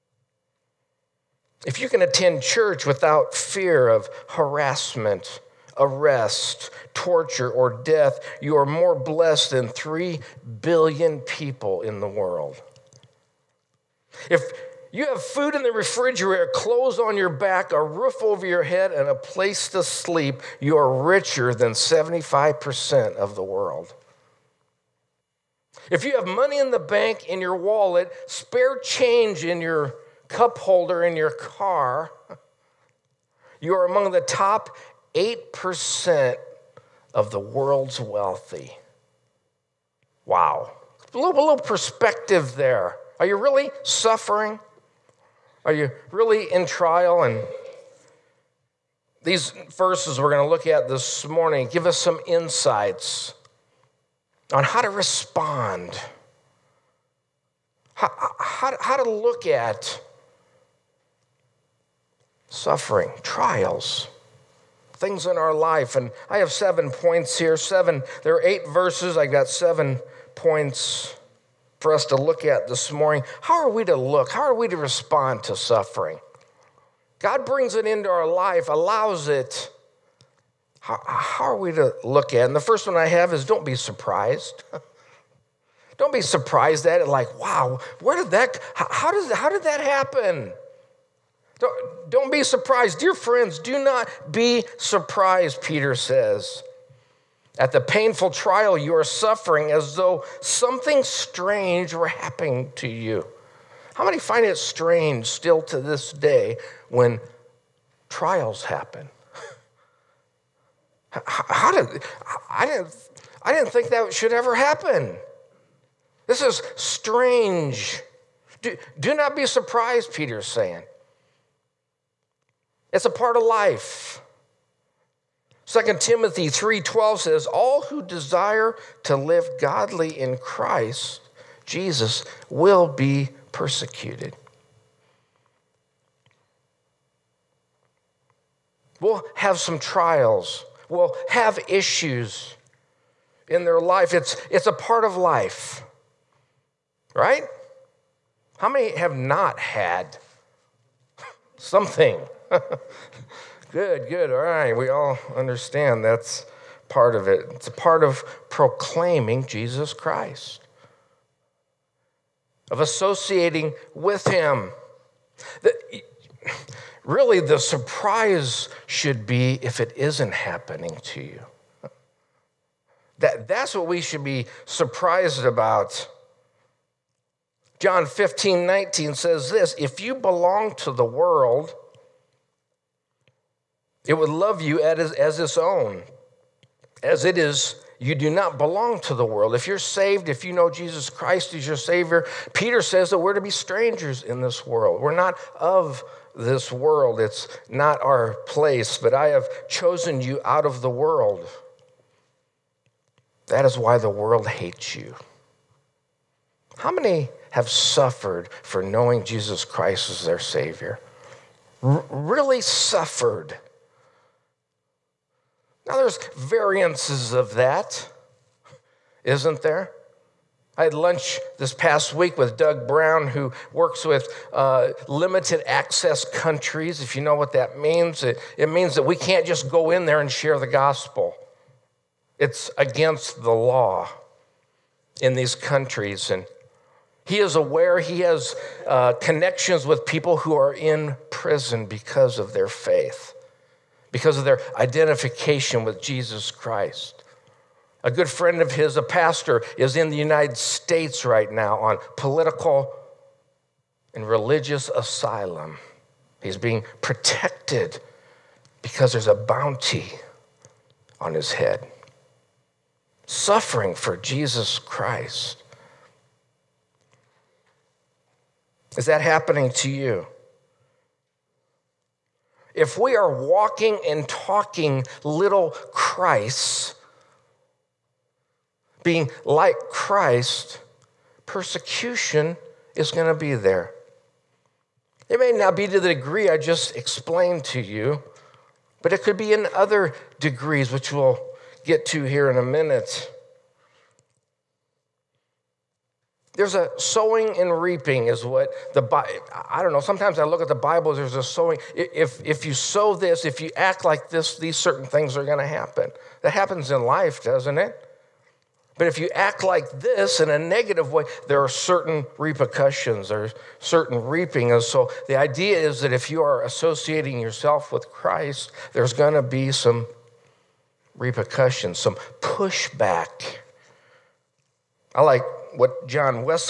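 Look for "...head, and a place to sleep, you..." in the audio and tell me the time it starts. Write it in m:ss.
0:18.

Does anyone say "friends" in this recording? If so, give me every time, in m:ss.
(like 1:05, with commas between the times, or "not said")
1:33, 4:08.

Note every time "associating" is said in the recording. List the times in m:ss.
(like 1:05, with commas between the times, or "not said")
2:42, 5:16.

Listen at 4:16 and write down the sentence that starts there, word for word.
He's being protected because there's a bounty on his head.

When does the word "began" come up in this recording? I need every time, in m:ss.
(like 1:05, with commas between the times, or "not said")
not said.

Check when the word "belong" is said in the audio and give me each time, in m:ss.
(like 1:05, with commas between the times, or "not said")
3:00, 3:08.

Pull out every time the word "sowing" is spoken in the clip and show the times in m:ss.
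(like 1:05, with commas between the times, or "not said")
4:56, 5:01.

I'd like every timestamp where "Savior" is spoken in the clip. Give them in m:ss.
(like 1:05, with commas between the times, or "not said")
3:11, 3:30.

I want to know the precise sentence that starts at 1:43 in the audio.
How many find it strange still to this day when trials happen?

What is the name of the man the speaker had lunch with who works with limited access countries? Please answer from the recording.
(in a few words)
Doug Brown.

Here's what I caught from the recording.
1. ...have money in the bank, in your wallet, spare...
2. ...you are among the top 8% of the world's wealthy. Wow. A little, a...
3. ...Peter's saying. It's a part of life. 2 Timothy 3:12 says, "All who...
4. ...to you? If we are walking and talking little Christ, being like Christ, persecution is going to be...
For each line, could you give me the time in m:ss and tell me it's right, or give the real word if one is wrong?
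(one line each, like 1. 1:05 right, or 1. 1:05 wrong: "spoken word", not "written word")
1. 0:26 right
2. 0:33 right
3. 2:00 right
4. 4:29 right.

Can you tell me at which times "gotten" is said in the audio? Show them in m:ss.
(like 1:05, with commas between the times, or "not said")
not said.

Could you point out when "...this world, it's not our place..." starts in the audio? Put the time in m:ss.
3:16.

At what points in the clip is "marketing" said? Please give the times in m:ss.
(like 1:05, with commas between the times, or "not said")
not said.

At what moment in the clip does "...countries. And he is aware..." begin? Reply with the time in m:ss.
3:55.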